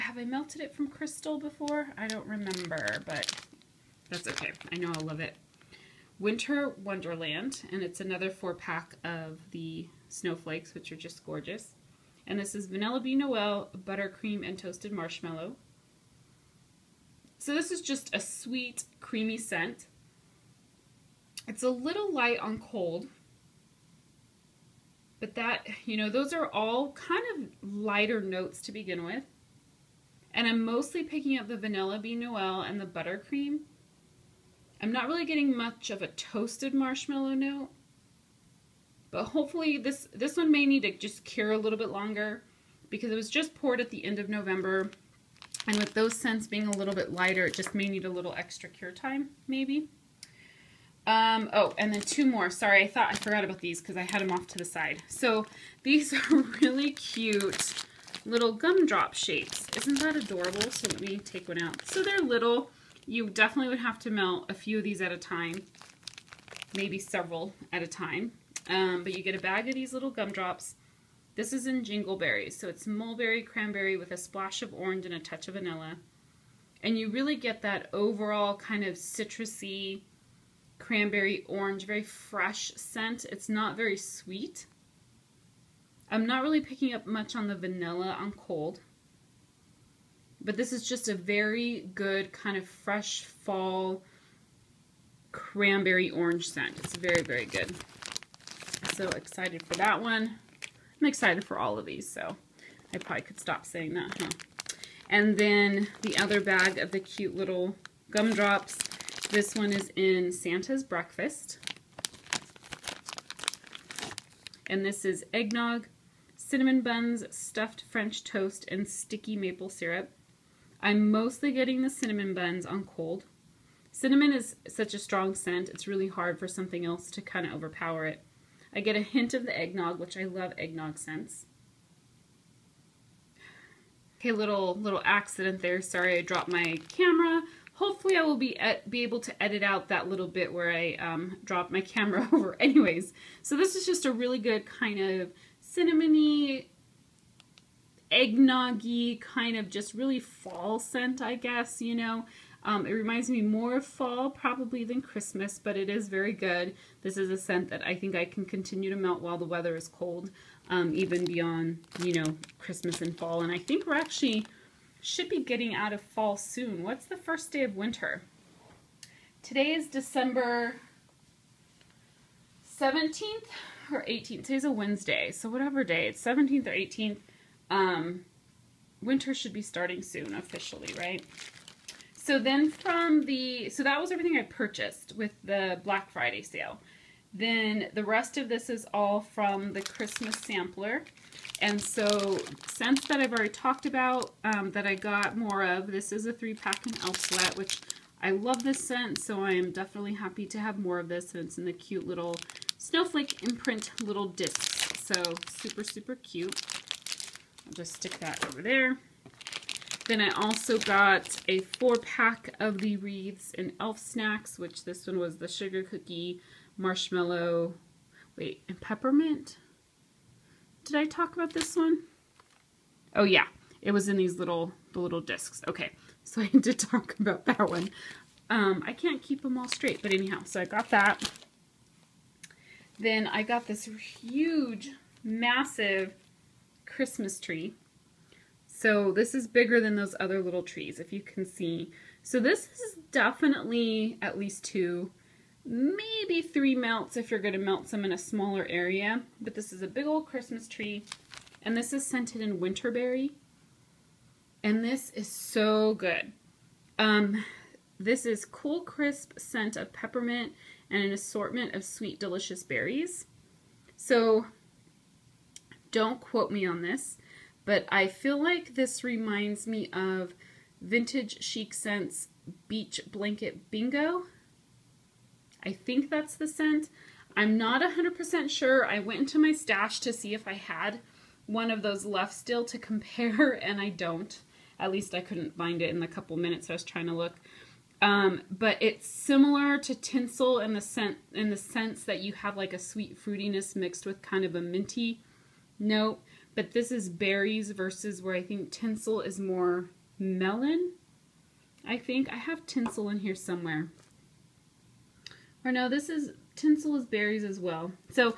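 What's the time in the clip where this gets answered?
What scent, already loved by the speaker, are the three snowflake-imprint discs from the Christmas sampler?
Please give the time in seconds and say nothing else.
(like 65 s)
197 s.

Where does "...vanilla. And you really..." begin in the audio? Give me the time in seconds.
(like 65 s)
75 s.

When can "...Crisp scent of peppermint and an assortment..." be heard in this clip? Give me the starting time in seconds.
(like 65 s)
258 s.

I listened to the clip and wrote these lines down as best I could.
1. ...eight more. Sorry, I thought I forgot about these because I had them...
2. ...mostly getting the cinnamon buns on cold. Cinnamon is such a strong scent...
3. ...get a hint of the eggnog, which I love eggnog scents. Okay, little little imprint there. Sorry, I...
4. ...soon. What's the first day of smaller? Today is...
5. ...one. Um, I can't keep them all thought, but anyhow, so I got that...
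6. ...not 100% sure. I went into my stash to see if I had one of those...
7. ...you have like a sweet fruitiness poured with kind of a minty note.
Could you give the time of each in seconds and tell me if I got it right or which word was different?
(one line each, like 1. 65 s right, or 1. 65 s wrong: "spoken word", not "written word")
1. 52 s wrong: "two", not "eight"
2. 121 s right
3. 128 s wrong: "accident", not "imprint"
4. 166 s wrong: "winter", not "smaller"
5. 227 s wrong: "straight", not "thought"
6. 277 s right
7. 292 s wrong: "mixed", not "poured".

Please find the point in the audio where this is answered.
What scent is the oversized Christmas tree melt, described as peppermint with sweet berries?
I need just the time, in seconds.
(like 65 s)
252 s.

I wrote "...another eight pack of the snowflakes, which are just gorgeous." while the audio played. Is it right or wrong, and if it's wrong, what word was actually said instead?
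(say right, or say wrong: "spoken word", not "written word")
wrong: "four", not "eight".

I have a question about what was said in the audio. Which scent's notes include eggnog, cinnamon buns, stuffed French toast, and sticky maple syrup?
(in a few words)
Santa's Breakfast.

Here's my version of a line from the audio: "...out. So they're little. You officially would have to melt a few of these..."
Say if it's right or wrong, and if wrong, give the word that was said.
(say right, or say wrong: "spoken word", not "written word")
wrong: "definitely", not "officially".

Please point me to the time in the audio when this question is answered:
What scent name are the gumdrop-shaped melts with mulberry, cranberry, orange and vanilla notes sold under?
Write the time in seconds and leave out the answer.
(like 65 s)
71 s.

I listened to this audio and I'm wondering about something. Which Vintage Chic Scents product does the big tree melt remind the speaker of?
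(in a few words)
Beach Blanket Bingo.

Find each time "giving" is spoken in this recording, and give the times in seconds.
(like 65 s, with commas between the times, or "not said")
not said.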